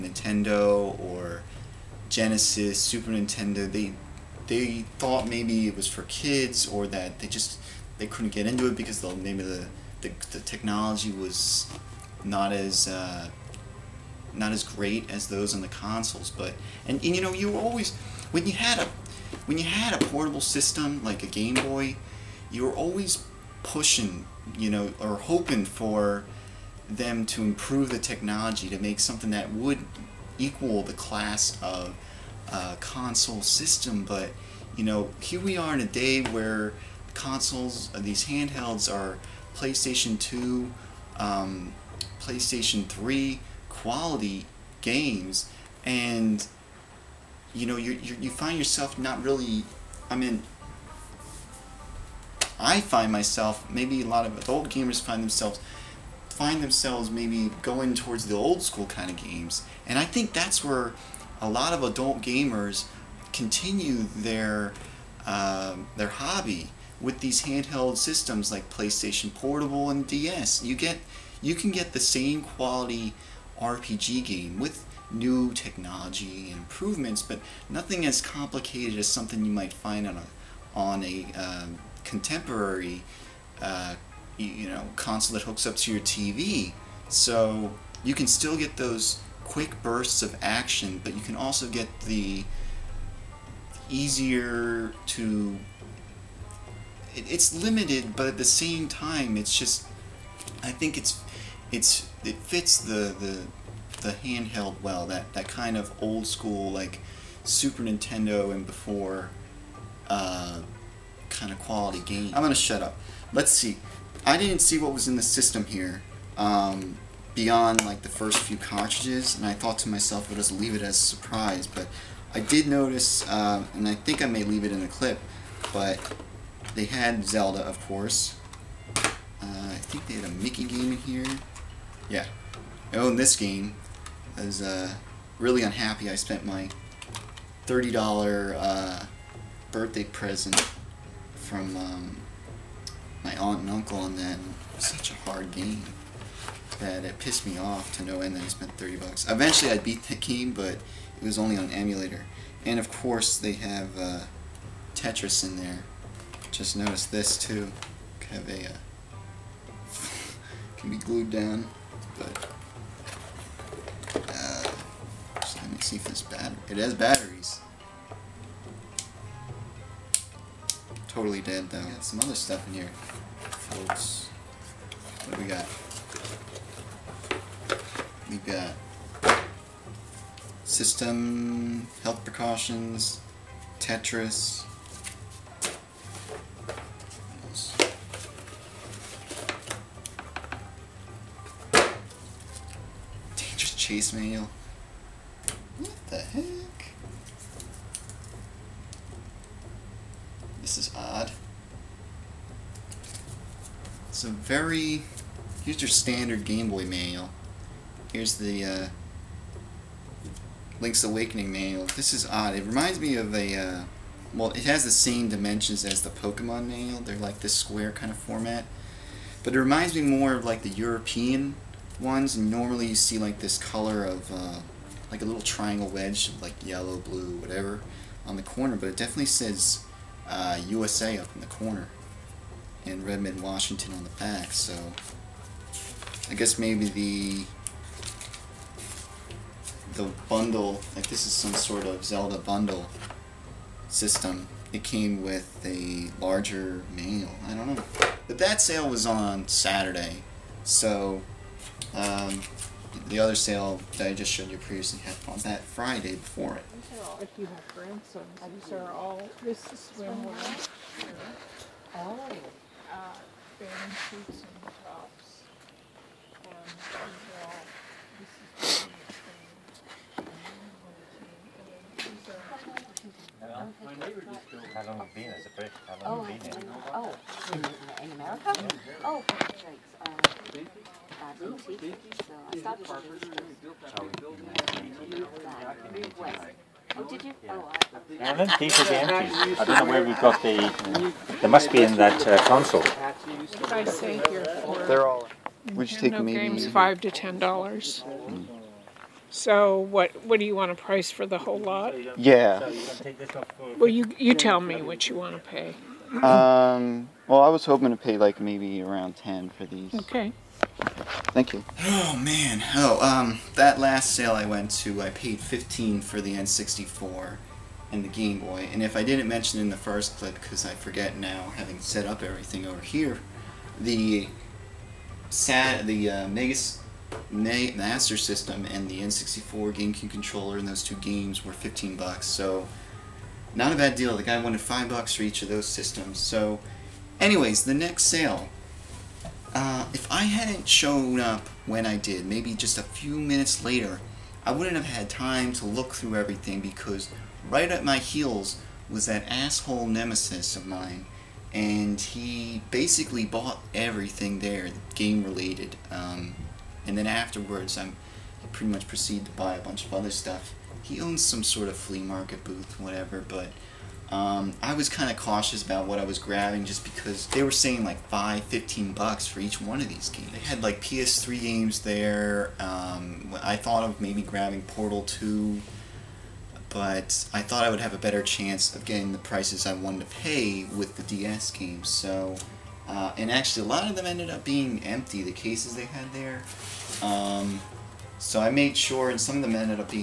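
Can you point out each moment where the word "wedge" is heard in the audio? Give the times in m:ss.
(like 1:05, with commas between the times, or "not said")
3:45.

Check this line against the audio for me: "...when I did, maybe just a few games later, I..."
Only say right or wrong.
wrong.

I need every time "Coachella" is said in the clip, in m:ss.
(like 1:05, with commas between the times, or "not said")
not said.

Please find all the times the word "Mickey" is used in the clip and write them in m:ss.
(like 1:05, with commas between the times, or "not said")
2:10.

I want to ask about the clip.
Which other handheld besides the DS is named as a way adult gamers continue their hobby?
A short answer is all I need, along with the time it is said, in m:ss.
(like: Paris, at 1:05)
PlayStation Portable, at 1:08.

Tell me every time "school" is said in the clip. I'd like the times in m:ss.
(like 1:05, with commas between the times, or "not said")
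0:58, 1:46.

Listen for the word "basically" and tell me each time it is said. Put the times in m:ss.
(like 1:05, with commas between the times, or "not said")
5:52.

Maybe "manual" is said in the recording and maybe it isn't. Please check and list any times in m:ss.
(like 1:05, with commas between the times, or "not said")
3:14, 3:26, 3:31, 3:36, 4:06.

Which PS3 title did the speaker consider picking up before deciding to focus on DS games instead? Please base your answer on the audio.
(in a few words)
Portal 2.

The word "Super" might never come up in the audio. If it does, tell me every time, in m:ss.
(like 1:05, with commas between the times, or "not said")
0:02, 1:47.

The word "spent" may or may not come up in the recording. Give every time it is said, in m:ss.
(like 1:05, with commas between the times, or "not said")
2:16, 2:28.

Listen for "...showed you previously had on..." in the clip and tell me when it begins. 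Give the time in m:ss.
4:14.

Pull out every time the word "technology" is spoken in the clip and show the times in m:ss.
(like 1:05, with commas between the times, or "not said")
0:10, 0:27, 1:15.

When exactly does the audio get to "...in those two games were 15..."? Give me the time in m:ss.
5:30.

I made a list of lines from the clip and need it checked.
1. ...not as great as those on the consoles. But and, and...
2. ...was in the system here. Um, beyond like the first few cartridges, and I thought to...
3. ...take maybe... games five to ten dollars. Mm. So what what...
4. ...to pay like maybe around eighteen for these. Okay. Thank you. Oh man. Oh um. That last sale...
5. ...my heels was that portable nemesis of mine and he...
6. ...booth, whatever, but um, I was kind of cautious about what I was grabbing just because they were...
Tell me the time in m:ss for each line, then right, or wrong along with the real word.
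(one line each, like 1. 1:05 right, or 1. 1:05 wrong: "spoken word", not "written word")
1. 0:14 right
2. 1:54 right
3. 4:55 right
4. 5:07 wrong: "ten", not "eighteen"
5. 5:47 wrong: "asshole", not "portable"
6. 6:02 right.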